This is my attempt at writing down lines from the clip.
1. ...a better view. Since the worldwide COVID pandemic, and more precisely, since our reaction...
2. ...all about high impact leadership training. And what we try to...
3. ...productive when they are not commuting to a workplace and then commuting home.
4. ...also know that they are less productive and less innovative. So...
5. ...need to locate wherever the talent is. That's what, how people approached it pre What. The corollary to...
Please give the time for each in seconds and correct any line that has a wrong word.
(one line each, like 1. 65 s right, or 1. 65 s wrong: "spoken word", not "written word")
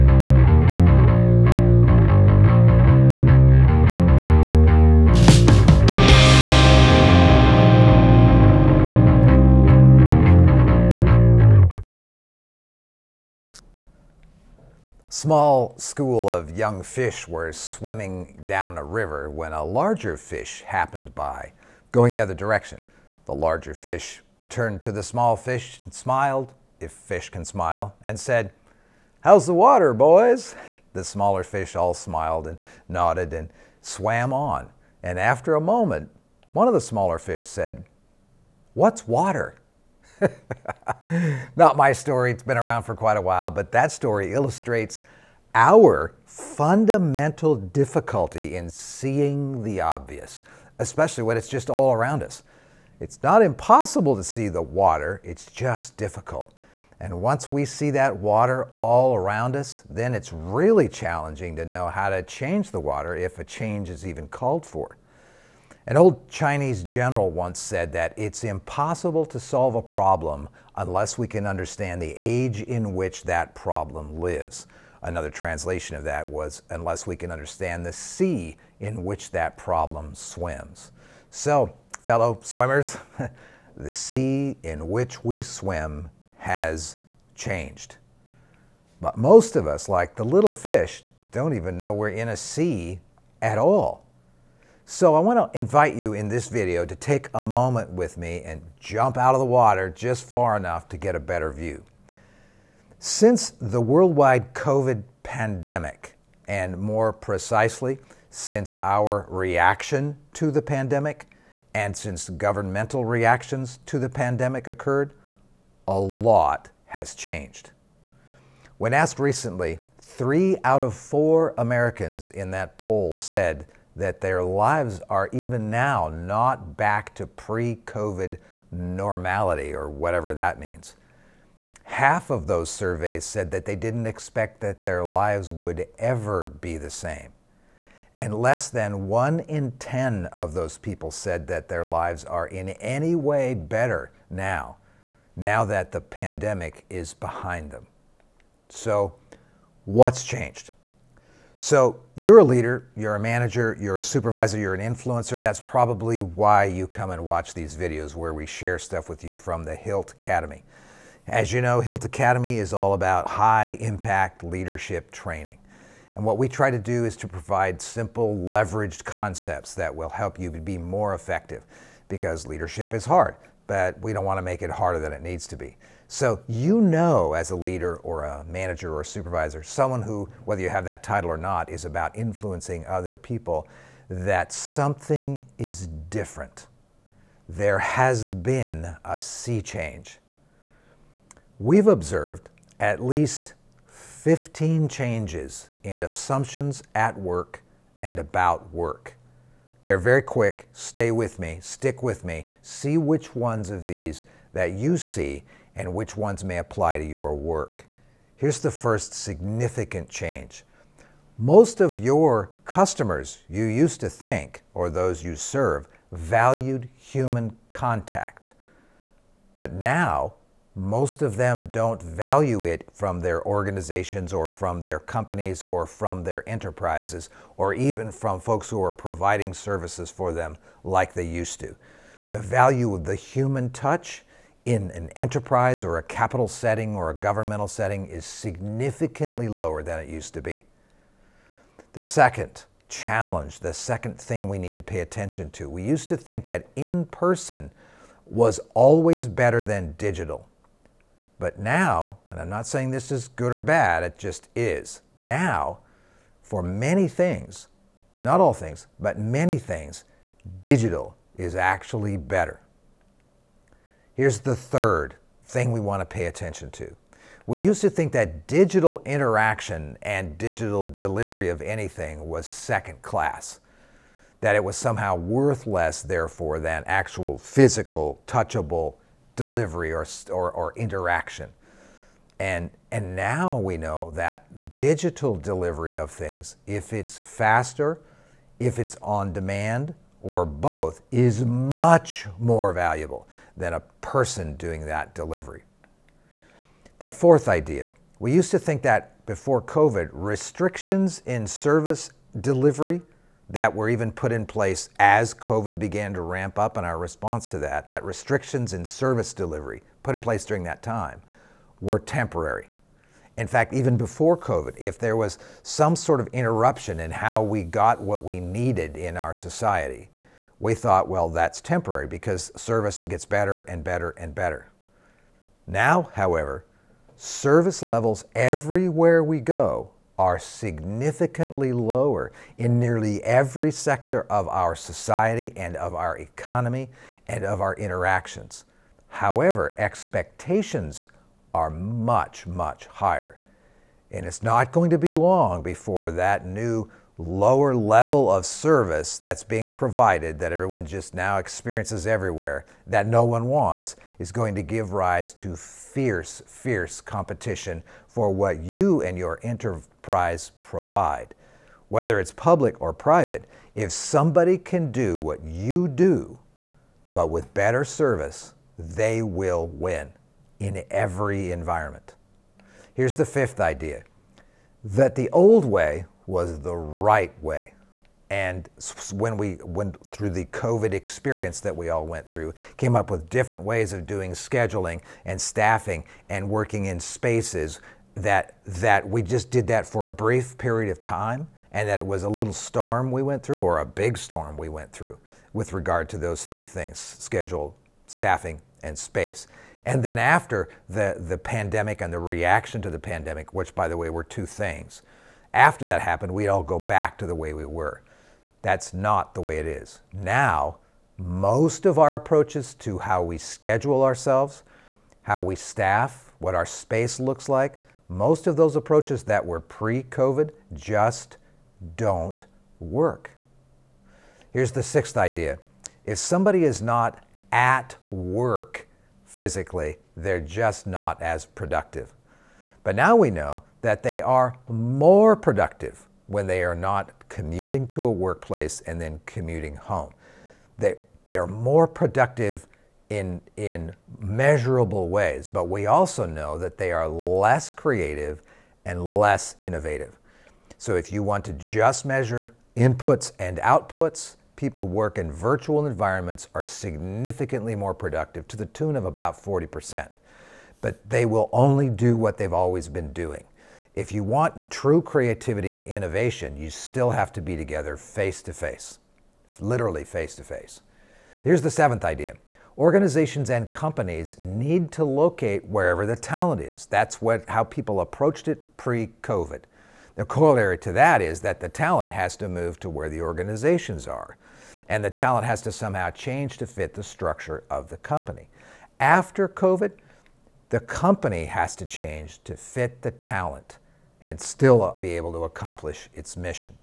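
1. 101 s right
2. 162 s right
3. 435 s right
4. 445 s wrong: "creative", not "productive"
5. 474 s wrong: "COVID", not "What".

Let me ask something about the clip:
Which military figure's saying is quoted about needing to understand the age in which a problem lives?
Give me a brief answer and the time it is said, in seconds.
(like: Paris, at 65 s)
an old Chinese general, at 65 s.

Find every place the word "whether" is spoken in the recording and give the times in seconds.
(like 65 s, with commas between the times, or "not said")
180 s, 361 s.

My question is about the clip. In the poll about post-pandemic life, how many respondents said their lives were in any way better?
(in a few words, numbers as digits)
less than 1 in 10.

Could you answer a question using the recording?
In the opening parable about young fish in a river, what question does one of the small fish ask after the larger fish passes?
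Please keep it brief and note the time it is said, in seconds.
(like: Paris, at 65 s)
What's water?, at 38 s.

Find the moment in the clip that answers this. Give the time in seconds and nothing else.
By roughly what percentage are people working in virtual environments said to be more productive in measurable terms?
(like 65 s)
459 s.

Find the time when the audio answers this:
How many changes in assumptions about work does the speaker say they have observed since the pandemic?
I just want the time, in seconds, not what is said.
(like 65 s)
193 s.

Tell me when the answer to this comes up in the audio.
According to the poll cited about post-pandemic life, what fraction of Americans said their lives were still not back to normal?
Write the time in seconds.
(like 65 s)
120 s.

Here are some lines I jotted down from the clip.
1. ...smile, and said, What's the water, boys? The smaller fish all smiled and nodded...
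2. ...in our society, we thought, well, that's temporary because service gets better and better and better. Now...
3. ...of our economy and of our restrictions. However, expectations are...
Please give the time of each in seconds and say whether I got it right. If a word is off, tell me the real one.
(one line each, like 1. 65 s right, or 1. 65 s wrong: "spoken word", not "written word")
1. 27 s wrong: "How", not "What"
2. 318 s right
3. 335 s wrong: "interactions", not "restrictions".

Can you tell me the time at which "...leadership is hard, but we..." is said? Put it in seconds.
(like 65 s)
172 s.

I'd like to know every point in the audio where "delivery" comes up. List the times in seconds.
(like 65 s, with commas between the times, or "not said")
270 s, 279 s, 285 s, 295 s, 302 s, 309 s.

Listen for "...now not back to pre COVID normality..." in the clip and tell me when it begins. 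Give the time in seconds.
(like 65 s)
125 s.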